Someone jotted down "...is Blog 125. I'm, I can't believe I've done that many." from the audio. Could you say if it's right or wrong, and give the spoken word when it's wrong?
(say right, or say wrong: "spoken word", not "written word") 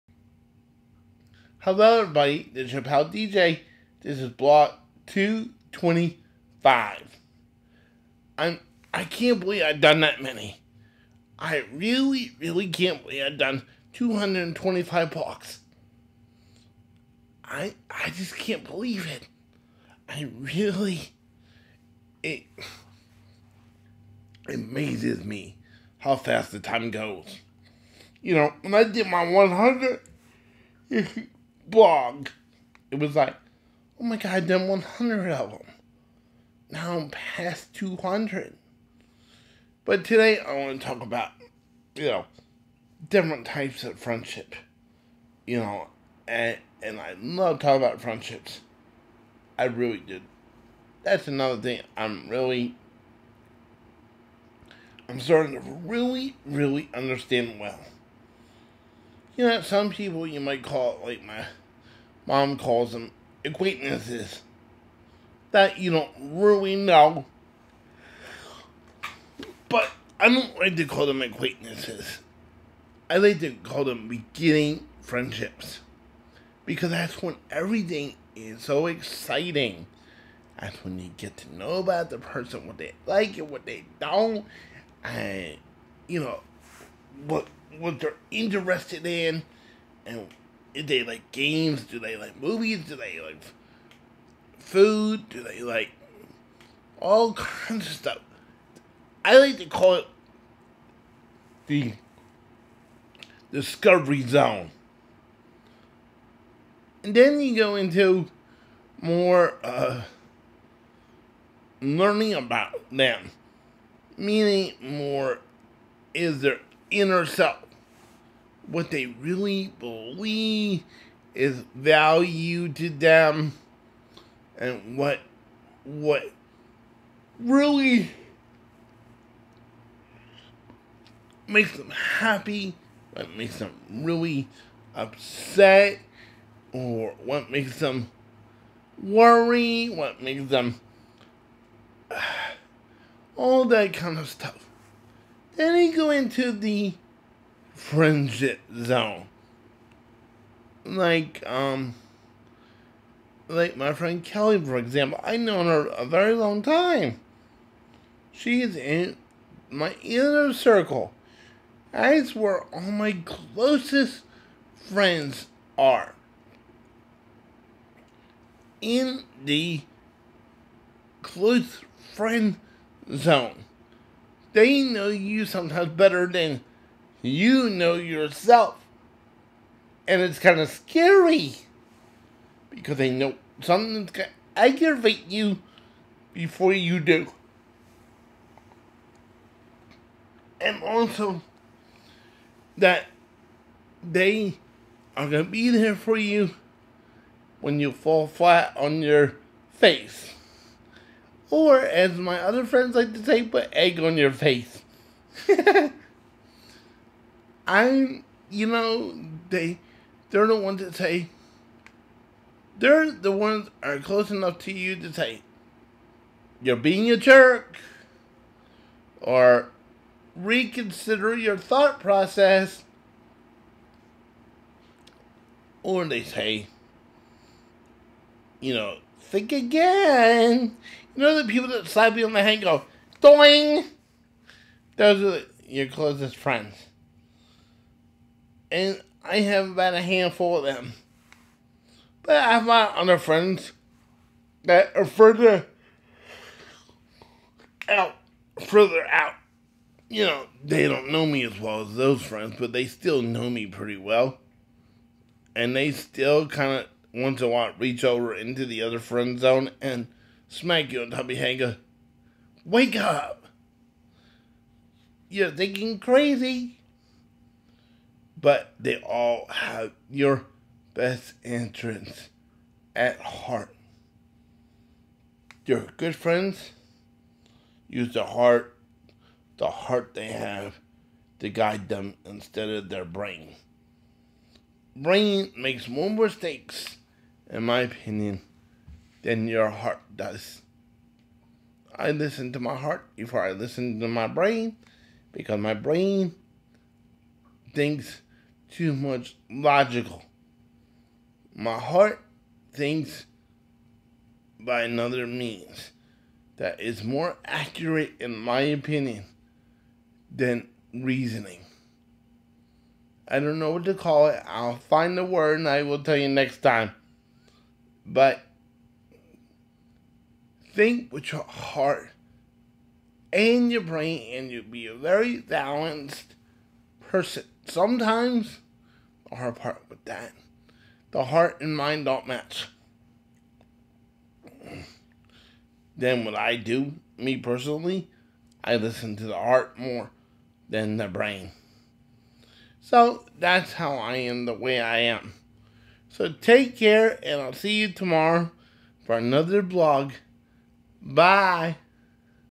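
wrong: "225", not "125".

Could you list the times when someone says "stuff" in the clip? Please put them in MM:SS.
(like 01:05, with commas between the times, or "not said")
01:37, 02:24.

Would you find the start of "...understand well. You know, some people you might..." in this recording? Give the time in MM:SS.
00:56.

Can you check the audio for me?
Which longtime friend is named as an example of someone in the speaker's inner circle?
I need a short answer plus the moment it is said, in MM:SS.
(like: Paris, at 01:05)
Kelly, at 02:34.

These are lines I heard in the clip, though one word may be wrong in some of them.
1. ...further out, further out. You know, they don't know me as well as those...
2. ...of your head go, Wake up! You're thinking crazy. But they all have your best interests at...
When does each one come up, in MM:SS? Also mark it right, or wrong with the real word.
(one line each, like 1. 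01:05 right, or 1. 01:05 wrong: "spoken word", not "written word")
1. 04:05 right
2. 04:21 right.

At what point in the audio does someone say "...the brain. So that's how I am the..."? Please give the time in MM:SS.
05:40.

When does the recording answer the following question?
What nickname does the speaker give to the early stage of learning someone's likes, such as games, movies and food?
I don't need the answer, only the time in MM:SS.
01:41.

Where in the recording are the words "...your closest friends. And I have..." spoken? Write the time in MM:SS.
03:55.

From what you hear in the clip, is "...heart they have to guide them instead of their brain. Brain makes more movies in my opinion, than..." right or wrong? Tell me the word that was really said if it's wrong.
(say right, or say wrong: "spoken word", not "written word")
wrong: "mistakes", not "movies".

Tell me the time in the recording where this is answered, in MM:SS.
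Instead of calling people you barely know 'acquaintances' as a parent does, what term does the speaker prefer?
01:14.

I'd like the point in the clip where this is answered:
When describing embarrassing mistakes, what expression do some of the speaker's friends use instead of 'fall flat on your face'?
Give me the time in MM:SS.
03:23.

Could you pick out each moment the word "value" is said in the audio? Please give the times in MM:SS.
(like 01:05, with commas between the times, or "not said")
02:01.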